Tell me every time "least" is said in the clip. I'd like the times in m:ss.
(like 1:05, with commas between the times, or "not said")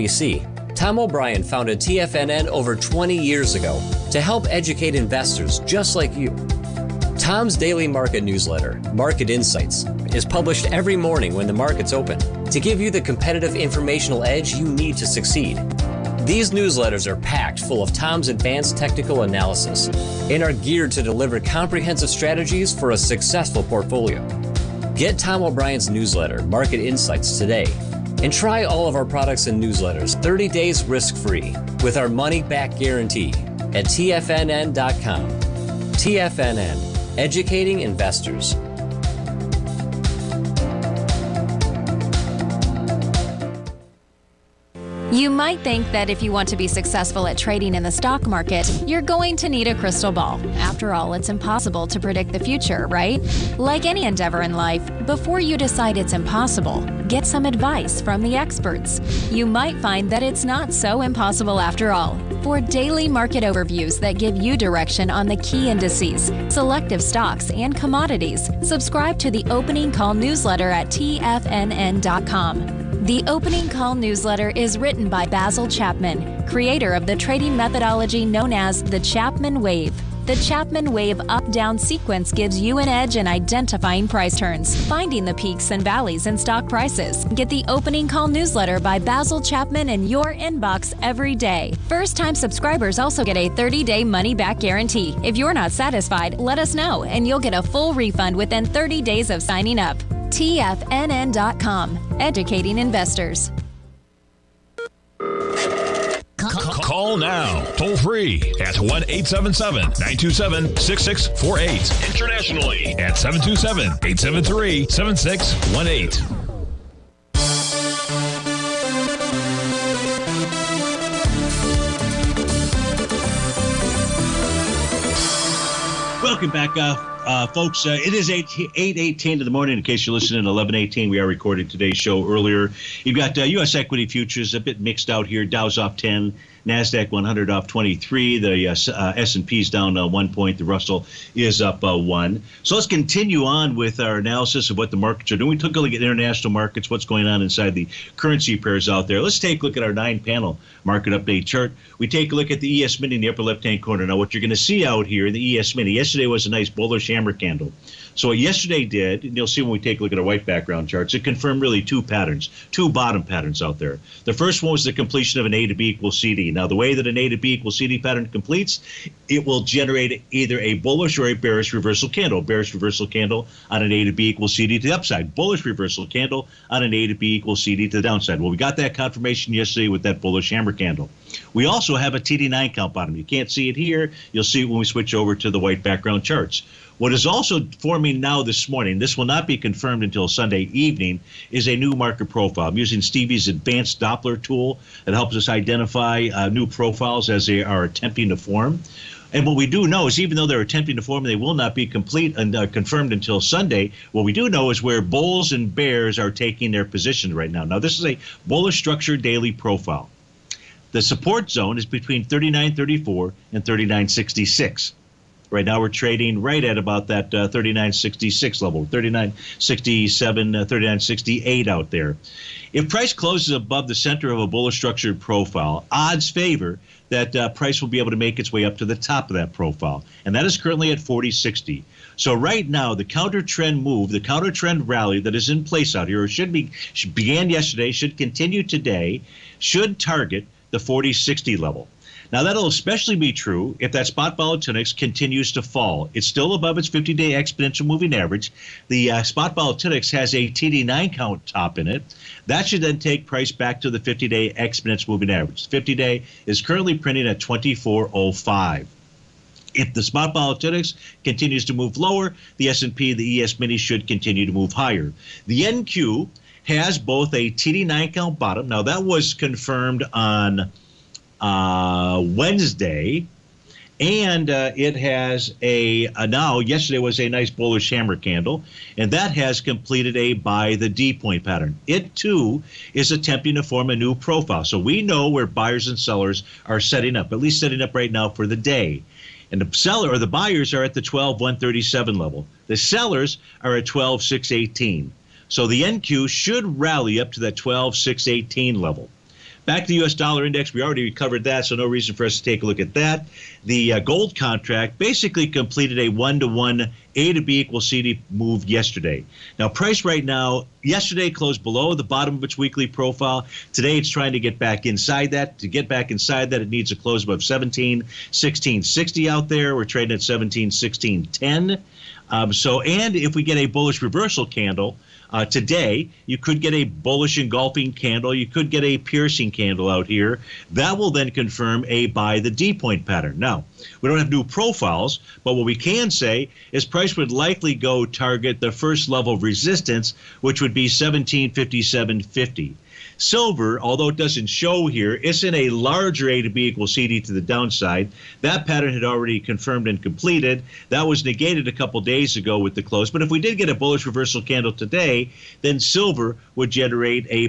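4:47.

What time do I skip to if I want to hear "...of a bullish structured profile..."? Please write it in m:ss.
3:44.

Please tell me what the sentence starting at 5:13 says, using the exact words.
Today, it's trying to get back inside that.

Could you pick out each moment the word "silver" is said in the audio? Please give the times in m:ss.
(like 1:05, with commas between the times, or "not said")
5:43, 5:55.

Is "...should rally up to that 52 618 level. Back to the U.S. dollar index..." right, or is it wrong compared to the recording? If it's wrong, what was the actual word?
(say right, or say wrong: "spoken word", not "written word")
wrong: "12", not "52".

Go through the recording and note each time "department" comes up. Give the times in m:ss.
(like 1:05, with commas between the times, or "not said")
not said.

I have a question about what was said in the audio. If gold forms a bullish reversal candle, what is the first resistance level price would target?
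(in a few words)
1757.50.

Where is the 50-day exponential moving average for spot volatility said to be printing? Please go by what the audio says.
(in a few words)
2405.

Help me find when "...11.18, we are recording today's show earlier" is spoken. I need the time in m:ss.
2:10.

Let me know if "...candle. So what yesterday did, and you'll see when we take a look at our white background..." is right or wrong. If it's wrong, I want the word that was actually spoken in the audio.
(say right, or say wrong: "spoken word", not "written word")
right.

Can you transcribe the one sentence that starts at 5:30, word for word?
That will then confirm a buy the D point pattern.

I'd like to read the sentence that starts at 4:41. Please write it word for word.
It too is attempting to form a new profile.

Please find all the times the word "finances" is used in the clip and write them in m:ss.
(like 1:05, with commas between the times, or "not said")
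not said.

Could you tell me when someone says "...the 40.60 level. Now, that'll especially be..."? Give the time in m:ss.
4:00.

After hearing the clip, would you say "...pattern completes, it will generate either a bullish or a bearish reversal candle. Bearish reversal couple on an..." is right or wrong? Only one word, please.
wrong.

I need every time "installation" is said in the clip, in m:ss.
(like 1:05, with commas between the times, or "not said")
not said.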